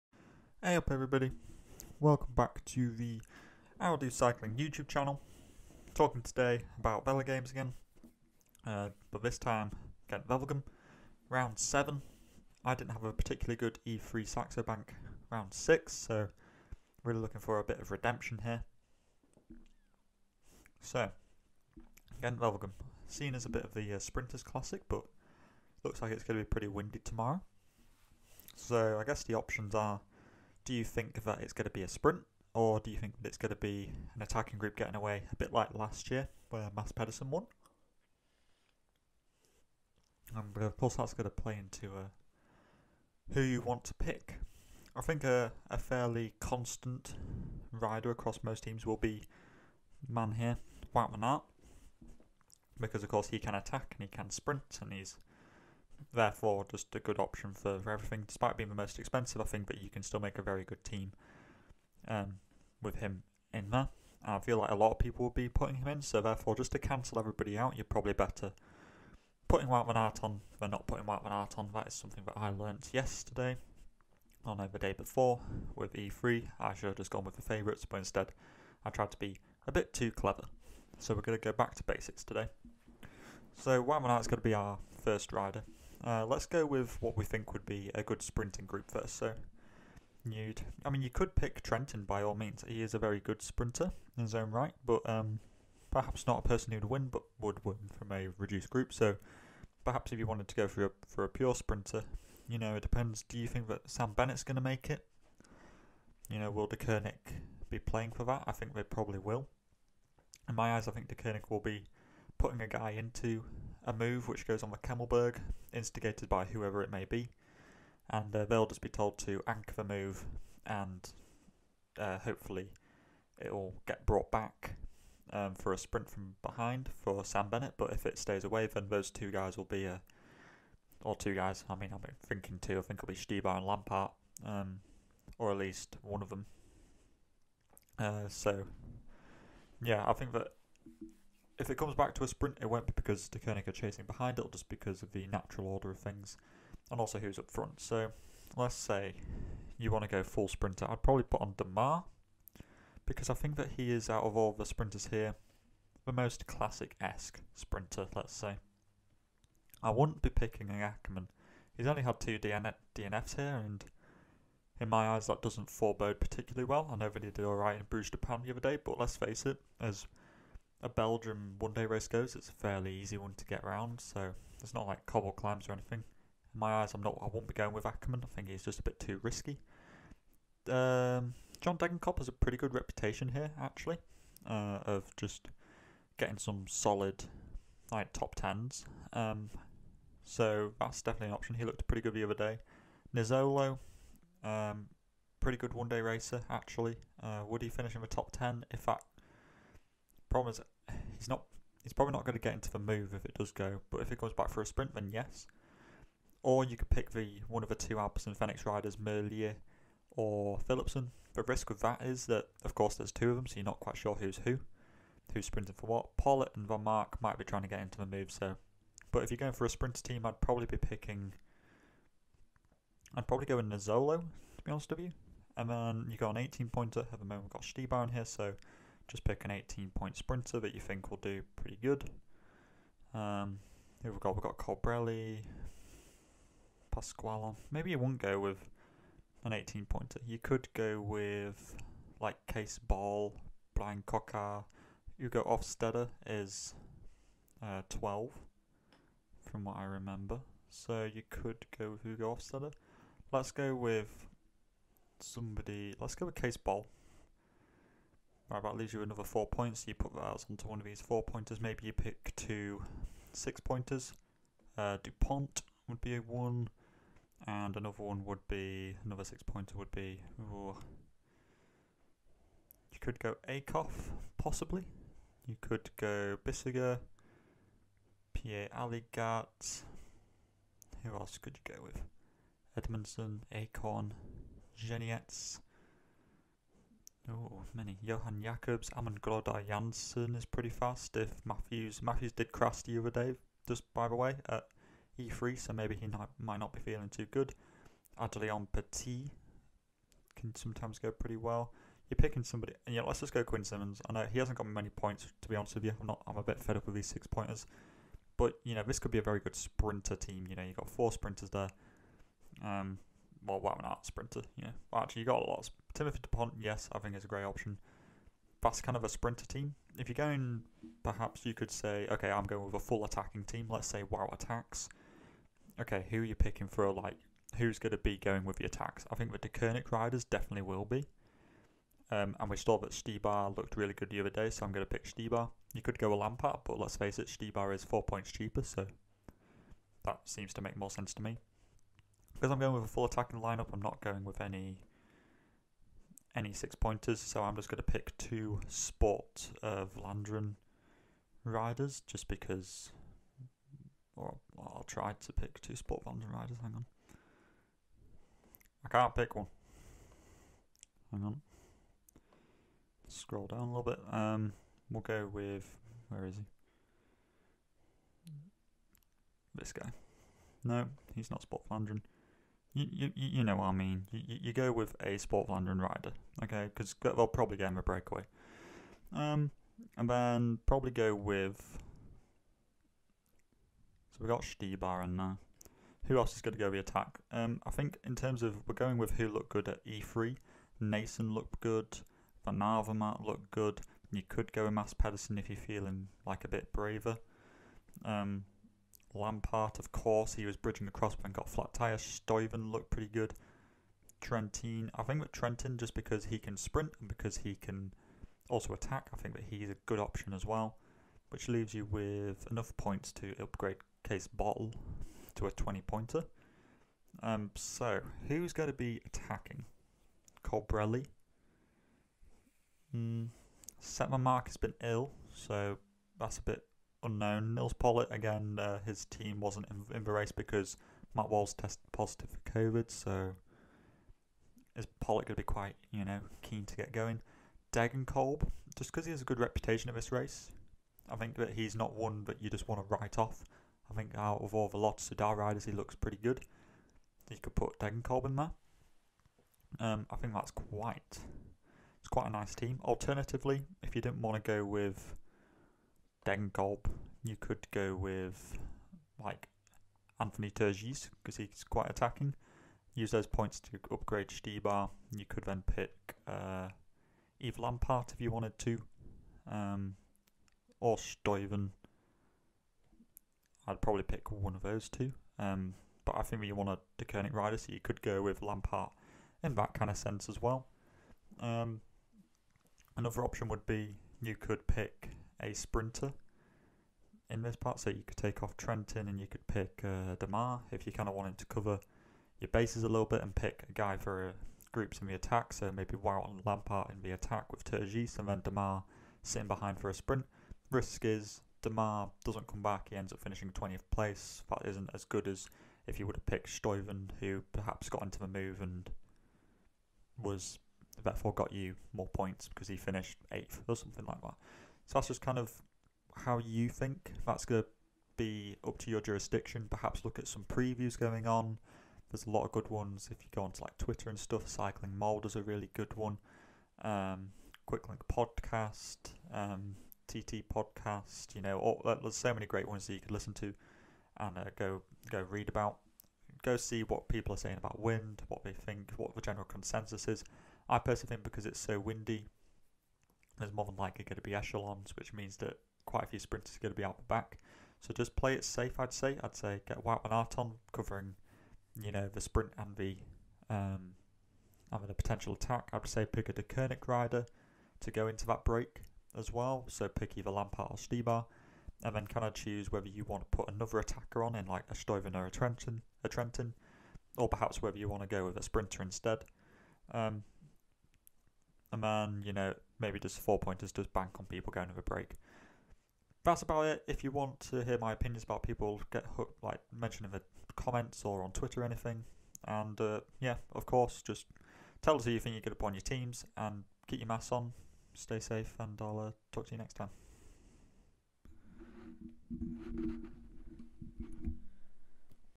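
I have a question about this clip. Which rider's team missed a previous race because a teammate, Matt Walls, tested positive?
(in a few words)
Nils Politt.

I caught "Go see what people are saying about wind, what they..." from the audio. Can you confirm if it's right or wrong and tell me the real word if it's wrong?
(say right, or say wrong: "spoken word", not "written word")
right.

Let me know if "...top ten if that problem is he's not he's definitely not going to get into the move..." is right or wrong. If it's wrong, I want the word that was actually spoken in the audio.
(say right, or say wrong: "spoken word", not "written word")
wrong: "probably", not "definitely".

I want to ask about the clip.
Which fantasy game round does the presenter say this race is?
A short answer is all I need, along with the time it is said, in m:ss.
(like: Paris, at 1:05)
7, at 0:11.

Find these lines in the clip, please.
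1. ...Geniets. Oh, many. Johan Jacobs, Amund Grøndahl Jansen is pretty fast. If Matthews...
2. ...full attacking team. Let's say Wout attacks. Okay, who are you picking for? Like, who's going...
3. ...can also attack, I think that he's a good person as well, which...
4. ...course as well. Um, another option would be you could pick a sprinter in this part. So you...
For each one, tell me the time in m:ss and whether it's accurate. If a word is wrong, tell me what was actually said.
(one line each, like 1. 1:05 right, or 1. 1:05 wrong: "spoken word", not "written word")
1. 4:44 right
2. 5:22 right
3. 6:47 wrong: "option", not "person"
4. 7:59 wrong: "sense", not "course".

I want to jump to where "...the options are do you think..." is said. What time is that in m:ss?
0:29.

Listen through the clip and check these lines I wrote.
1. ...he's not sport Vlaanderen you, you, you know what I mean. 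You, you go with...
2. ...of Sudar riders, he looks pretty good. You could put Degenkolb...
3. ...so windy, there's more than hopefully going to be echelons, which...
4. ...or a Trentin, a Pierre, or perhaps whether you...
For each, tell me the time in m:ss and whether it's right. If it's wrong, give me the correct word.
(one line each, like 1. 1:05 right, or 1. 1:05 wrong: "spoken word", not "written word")
1. 6:11 right
2. 7:25 right
3. 9:01 wrong: "likely", not "hopefully"
4. 9:25 wrong: "Trentin", not "Pierre".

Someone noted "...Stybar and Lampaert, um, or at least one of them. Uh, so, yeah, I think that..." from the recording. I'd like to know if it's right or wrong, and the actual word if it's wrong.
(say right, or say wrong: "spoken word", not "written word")
right.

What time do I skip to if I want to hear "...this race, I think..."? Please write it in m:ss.
7:19.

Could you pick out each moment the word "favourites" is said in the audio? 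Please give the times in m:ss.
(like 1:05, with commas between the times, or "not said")
1:17.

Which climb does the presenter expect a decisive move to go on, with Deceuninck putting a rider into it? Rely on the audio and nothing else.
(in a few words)
Kemmelberg.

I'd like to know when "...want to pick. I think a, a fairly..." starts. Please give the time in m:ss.
0:43.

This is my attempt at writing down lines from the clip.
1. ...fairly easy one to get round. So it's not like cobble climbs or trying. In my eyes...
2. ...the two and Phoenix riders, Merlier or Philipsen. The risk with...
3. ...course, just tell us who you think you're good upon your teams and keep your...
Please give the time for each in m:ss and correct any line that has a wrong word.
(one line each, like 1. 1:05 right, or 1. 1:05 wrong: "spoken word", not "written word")
1. 2:52 wrong: "anything", not "trying"
2. 3:27 right
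3. 9:43 right.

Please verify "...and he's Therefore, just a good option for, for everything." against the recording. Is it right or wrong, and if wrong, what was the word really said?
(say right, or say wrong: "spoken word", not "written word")
right.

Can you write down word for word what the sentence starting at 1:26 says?
Uh, let's go with what we think would be a good sprinting group first.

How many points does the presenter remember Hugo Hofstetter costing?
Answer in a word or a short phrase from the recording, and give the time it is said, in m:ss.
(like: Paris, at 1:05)
12, at 4:07.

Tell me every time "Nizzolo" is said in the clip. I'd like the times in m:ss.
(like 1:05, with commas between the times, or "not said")
3:13, 3:43.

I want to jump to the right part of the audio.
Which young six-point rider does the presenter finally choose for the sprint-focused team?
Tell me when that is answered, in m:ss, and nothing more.
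5:03.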